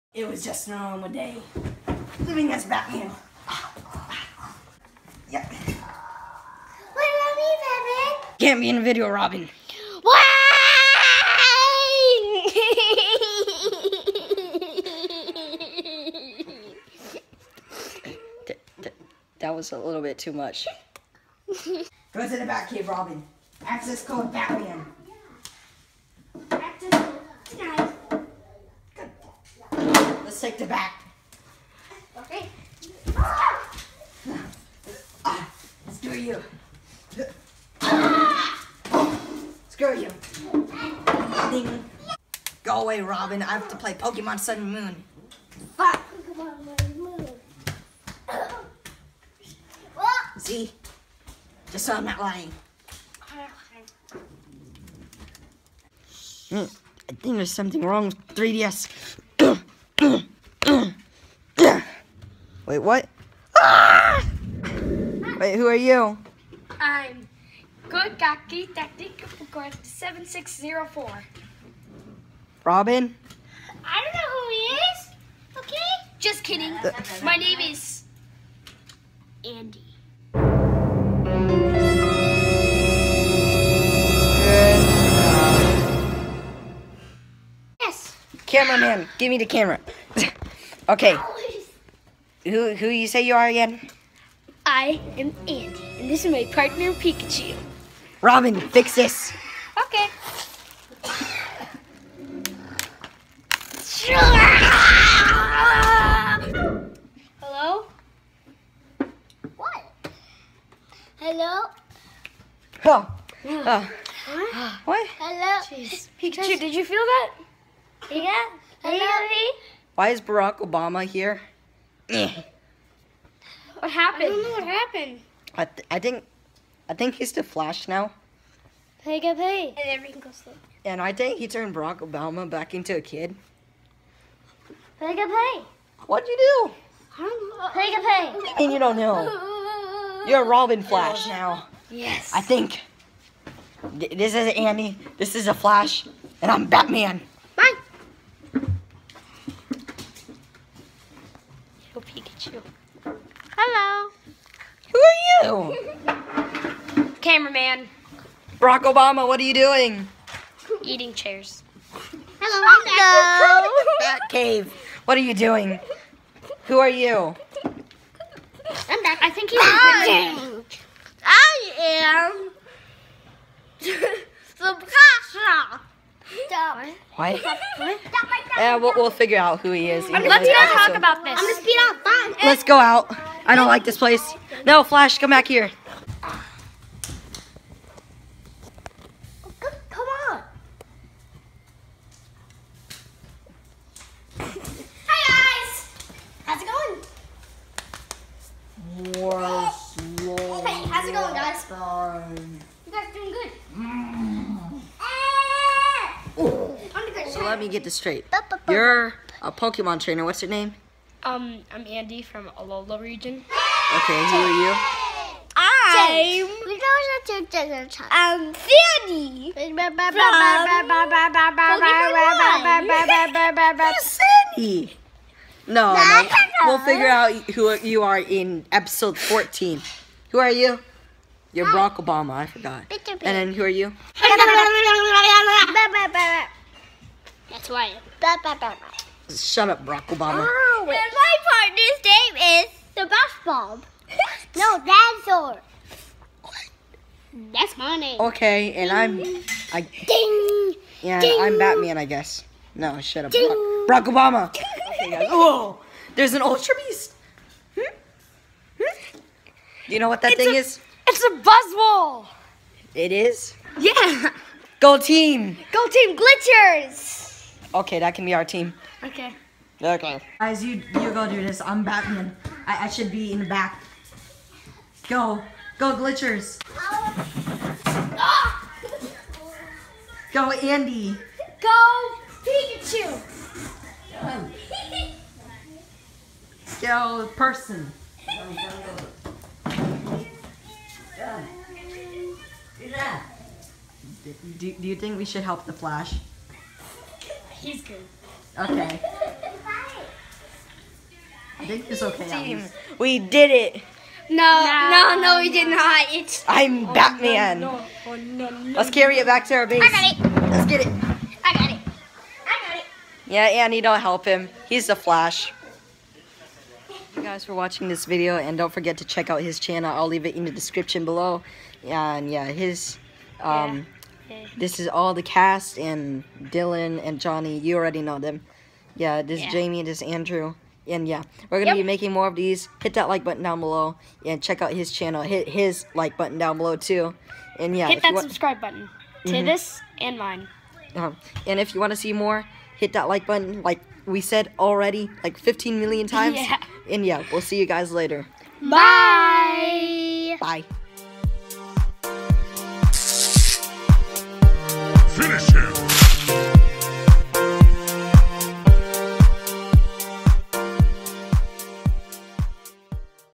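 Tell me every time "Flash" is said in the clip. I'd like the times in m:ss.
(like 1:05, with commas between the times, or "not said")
2:07, 2:20, 2:25, 3:04, 4:55, 5:14.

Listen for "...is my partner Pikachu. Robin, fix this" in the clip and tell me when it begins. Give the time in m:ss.
1:36.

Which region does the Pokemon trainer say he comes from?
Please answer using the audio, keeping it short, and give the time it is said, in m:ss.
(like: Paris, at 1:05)
Alola, at 3:32.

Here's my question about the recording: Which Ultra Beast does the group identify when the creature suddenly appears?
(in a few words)
Buzzwole.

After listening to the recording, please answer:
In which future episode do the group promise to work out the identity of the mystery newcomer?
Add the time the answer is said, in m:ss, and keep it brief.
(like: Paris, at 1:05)
Episode 14, at 3:48.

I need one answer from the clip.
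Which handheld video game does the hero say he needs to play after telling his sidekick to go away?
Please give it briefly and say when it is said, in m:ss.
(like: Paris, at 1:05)
Pokemon Sun and Moon, at 0:43.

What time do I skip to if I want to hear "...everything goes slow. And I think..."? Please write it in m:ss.
2:09.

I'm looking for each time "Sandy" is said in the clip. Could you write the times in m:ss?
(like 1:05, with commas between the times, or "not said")
3:38, 3:44.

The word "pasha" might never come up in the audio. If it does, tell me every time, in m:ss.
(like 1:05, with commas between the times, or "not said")
2:54.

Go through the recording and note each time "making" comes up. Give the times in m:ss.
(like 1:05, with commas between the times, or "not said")
5:31.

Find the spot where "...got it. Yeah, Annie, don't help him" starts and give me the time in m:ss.
5:12.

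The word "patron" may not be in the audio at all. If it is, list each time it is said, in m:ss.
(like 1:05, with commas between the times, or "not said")
not said.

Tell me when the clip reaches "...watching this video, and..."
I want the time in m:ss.
5:17.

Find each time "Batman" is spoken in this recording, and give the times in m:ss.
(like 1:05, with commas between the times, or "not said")
0:02, 0:07, 0:24, 2:26, 4:11, 4:31, 5:06.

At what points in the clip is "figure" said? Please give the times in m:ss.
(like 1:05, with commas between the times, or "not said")
2:59, 3:46.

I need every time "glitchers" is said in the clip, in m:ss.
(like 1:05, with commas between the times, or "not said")
4:26, 4:35.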